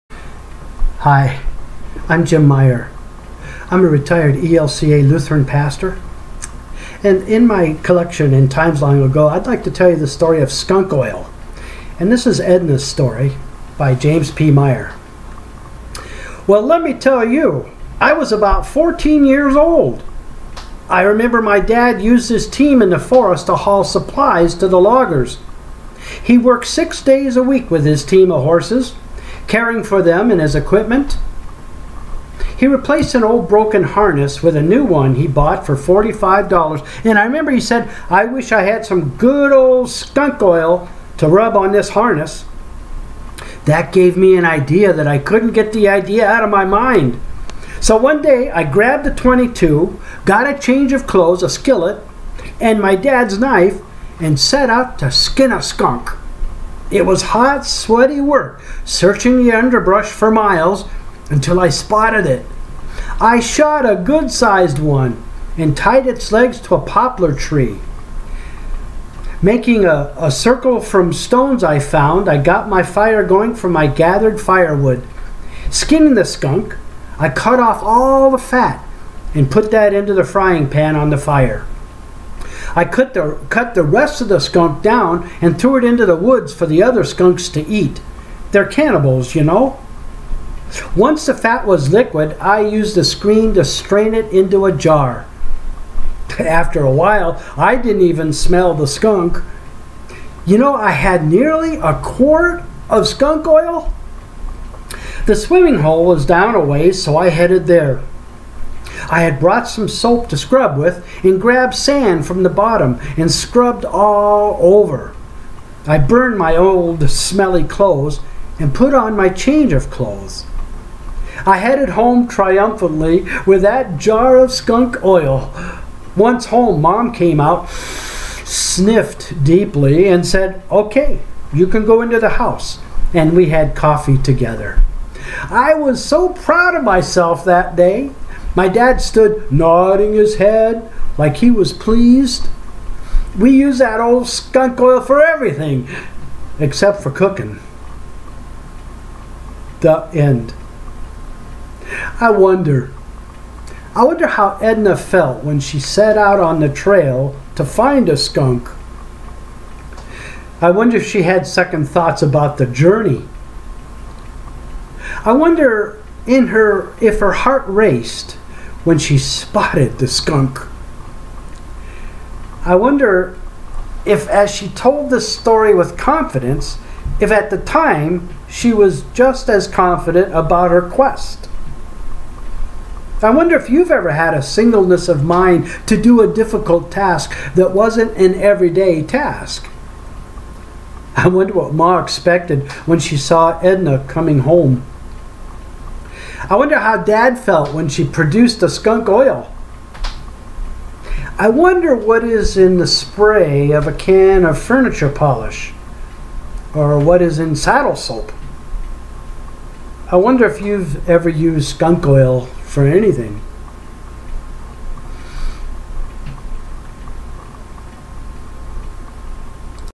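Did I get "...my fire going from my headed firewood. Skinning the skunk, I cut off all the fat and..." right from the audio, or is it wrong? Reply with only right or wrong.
wrong.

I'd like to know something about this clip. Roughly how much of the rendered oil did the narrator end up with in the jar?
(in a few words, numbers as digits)
Nearly a quart.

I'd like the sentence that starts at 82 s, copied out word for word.
I cut the, cut the rest of the skunk down and threw it into the woods for the other skunks to eat.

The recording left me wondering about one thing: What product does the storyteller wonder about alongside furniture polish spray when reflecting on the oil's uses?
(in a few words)
Saddle soap.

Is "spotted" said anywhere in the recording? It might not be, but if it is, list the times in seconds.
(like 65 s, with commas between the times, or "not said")
61 s, 169 s.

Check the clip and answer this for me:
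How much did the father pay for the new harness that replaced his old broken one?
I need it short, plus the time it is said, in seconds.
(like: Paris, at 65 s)
$45, at 35 s.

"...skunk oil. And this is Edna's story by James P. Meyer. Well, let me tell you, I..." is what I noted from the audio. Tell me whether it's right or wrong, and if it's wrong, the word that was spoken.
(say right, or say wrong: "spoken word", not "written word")
right.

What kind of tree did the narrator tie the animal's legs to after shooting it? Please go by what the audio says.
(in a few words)
Poplar.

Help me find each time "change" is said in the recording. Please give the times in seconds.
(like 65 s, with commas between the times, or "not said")
50 s, 119 s.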